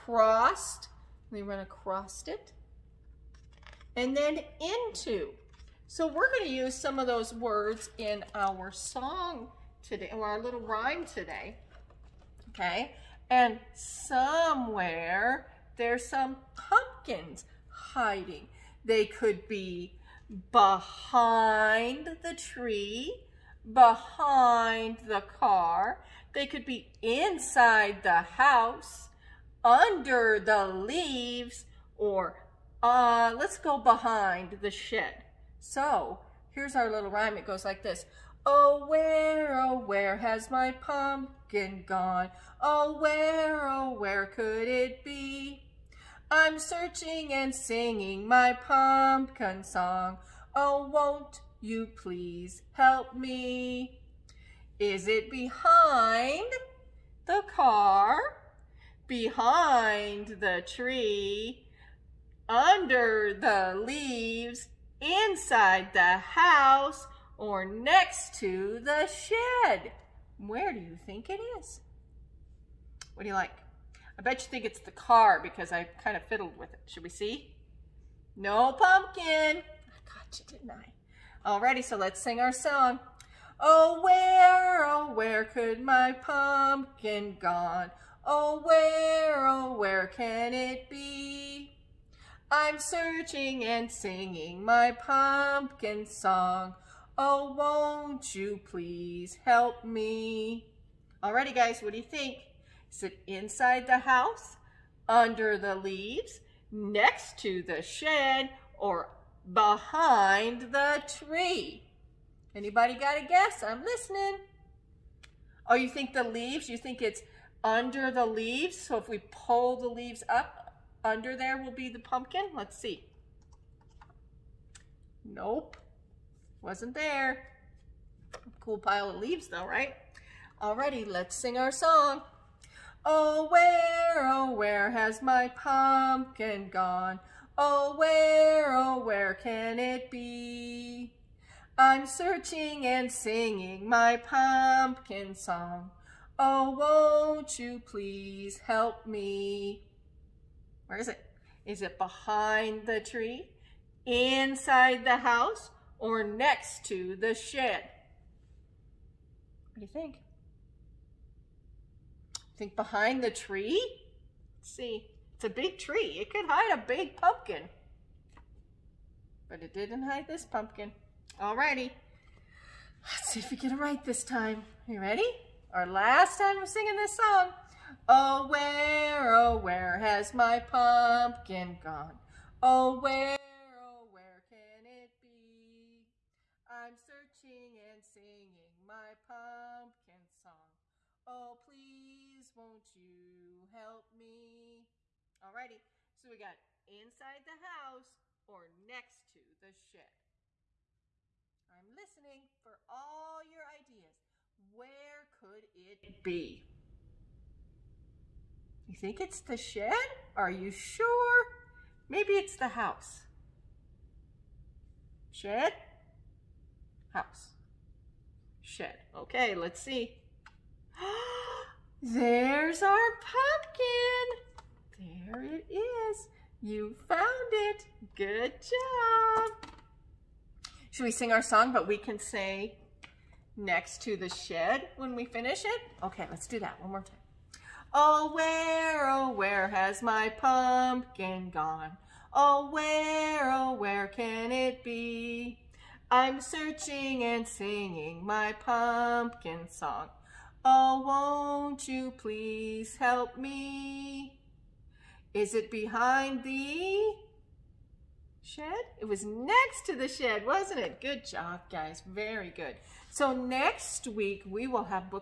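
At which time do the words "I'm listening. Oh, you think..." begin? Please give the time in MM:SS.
01:53.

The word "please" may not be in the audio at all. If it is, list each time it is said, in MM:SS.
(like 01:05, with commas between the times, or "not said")
00:51, 01:38, 02:27, 03:11, 04:12.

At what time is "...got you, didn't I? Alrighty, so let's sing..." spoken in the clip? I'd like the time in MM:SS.
01:20.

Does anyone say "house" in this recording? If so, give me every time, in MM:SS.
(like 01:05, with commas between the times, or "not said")
00:28, 01:06, 01:43, 02:35, 03:17, 03:32, 03:37.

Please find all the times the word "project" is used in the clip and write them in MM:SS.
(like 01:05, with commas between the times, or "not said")
not said.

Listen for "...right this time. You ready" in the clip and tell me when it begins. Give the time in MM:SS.
02:53.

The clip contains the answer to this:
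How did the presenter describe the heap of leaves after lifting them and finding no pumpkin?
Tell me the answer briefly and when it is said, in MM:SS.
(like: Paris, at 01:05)
cool pile of leaves, at 02:08.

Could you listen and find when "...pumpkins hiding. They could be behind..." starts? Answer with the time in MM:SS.
00:16.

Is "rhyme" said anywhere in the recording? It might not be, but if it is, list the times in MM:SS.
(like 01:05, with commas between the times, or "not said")
00:10, 00:37.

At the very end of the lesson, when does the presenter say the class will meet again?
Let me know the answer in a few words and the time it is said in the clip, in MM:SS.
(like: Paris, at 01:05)
next week, at 04:23.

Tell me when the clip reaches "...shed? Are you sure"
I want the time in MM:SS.
03:29.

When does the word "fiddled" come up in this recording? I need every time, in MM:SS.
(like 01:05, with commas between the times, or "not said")
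01:16.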